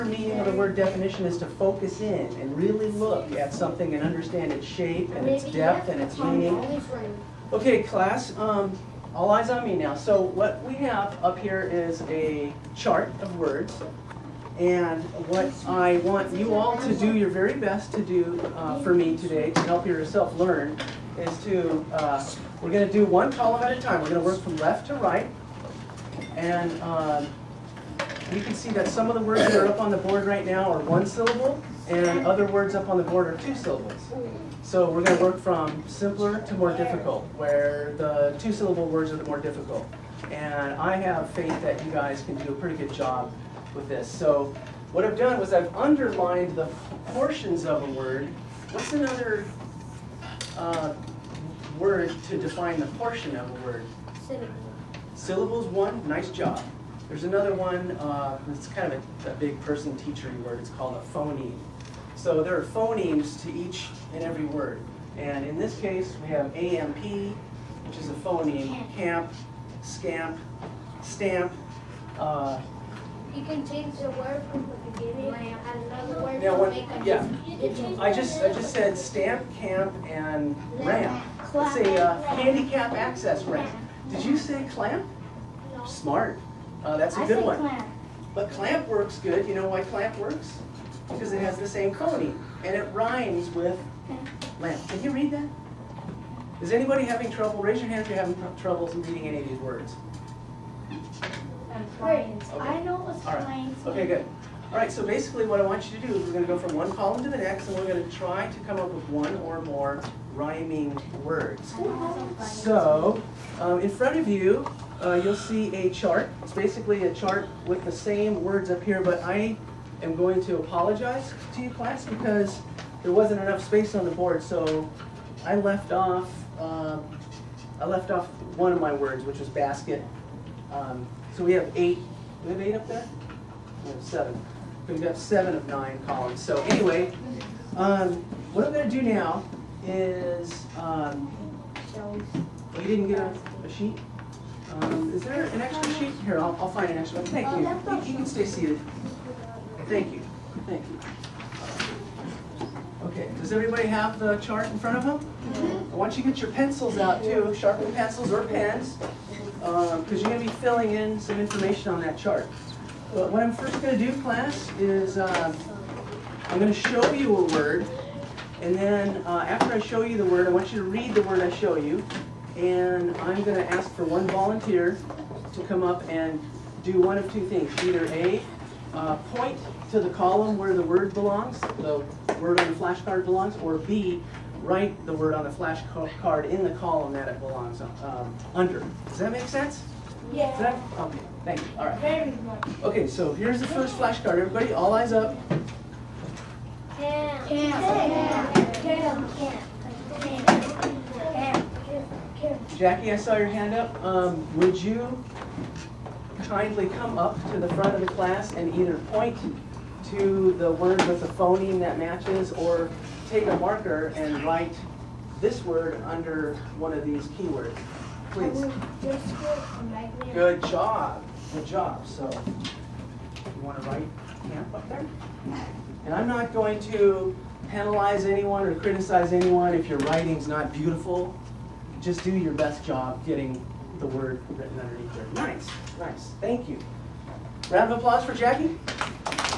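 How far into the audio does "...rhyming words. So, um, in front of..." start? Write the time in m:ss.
1:50.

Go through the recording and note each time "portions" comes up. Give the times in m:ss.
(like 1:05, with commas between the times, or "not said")
0:47, 0:52.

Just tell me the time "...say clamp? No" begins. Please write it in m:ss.
1:24.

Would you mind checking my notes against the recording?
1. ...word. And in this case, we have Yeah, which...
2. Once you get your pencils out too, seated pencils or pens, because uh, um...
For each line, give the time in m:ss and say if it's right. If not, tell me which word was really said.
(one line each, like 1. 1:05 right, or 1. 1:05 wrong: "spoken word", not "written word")
1. 1:04 wrong: "AMP", not "Yeah"
2. 2:36 wrong: "sharpened", not "seated".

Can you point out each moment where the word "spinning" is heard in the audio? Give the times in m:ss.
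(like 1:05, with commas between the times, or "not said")
not said.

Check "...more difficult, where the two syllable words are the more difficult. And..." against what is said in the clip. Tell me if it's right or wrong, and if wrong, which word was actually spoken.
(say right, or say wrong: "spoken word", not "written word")
right.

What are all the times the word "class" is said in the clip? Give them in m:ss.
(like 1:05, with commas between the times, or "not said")
0:07, 2:01, 2:44, 3:28.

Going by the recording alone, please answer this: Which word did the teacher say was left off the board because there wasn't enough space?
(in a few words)
basket.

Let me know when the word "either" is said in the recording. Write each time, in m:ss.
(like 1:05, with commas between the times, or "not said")
2:57, 3:28.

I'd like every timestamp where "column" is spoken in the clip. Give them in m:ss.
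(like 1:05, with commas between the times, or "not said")
0:23, 1:46, 2:16, 3:00, 3:06.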